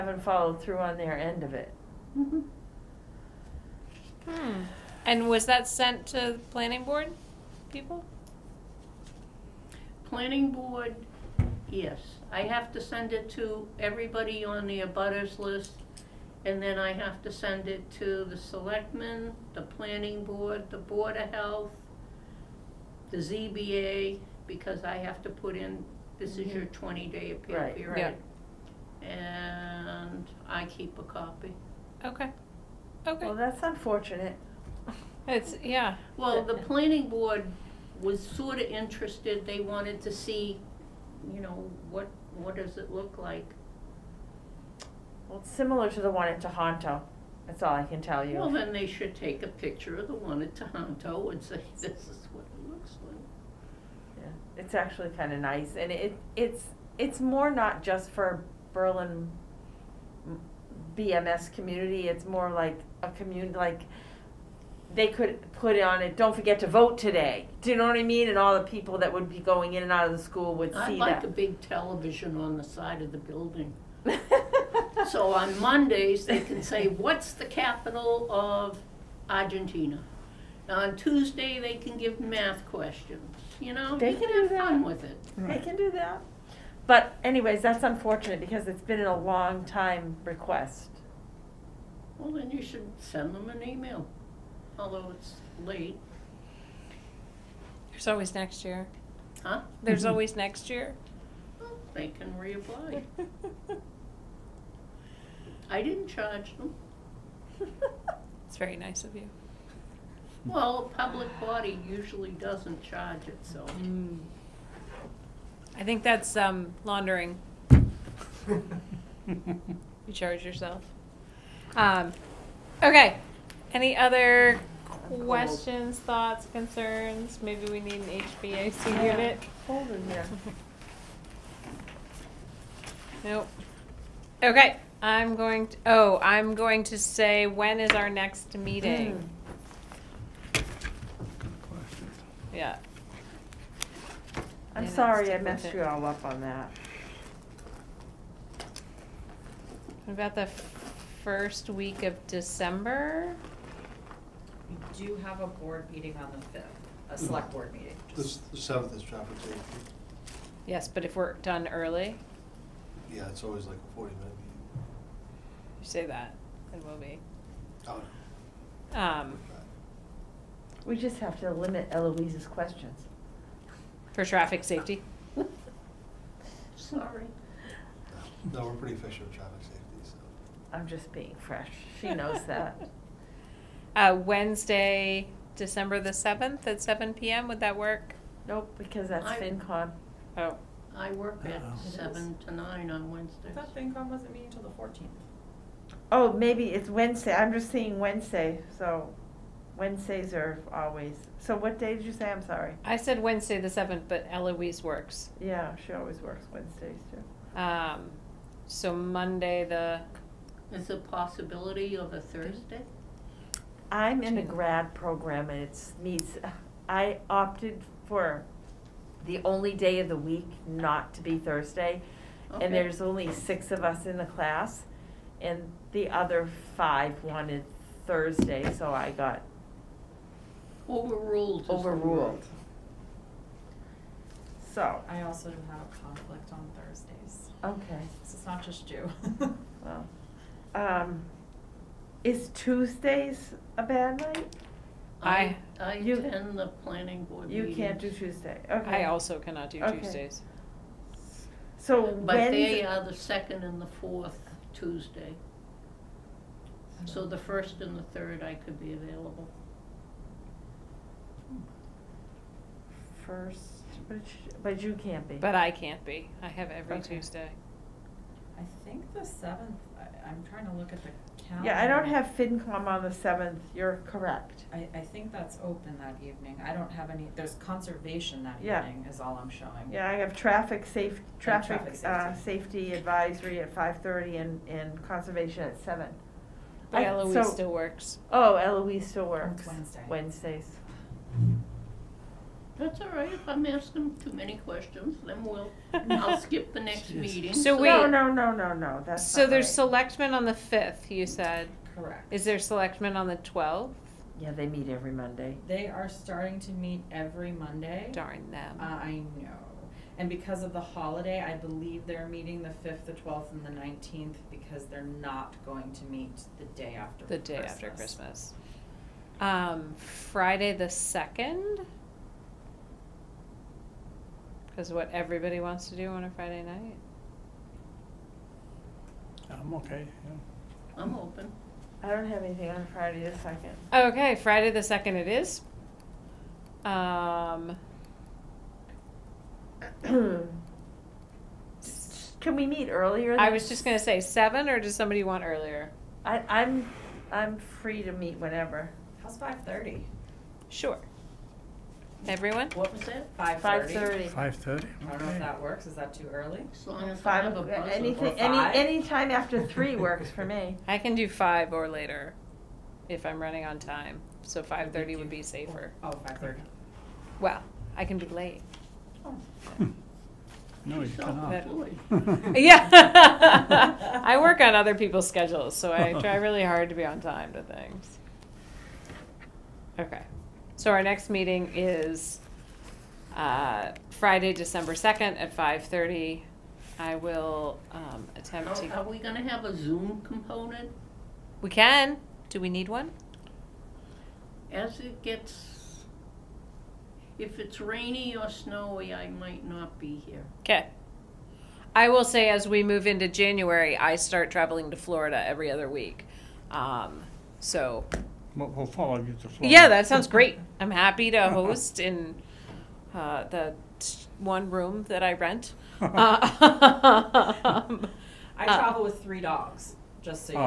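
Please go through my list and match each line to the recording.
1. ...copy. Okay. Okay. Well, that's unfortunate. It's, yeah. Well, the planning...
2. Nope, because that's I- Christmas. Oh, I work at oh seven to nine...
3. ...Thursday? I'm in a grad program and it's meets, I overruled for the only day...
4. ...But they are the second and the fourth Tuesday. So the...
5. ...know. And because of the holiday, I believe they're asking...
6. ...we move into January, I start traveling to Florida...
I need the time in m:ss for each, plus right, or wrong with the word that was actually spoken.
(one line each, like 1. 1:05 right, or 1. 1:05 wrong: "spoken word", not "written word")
1. 0:31 right
2. 3:08 wrong: "FinCom", not "Christmas"
3. 3:32 wrong: "opted", not "overruled"
4. 4:12 right
5. 5:09 wrong: "meeting", not "asking"
6. 6:42 right.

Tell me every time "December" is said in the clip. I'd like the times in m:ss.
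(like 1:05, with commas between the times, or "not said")
2:32, 3:05, 6:24.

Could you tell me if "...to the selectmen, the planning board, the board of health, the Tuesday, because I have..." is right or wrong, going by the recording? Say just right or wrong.
wrong.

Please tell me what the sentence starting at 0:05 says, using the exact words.
And was that sent to the planning board people?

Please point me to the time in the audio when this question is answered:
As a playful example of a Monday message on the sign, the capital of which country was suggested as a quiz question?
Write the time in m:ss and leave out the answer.
1:19.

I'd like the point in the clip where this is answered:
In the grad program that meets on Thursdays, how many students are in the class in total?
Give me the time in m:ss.
3:43.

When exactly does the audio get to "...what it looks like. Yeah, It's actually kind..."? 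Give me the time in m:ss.
0:52.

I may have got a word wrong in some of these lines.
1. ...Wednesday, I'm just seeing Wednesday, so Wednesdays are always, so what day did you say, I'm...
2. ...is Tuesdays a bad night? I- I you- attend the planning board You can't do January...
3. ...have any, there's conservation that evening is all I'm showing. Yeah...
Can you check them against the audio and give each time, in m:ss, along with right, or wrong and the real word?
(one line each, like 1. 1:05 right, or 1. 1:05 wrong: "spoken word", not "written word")
1. 3:16 right
2. 4:02 wrong: "Tuesday", not "January"
3. 4:36 right.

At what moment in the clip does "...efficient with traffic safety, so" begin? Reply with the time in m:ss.
2:58.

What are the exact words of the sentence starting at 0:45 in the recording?
Well, it's similar to the one at Tahanto, that's all I can tell you.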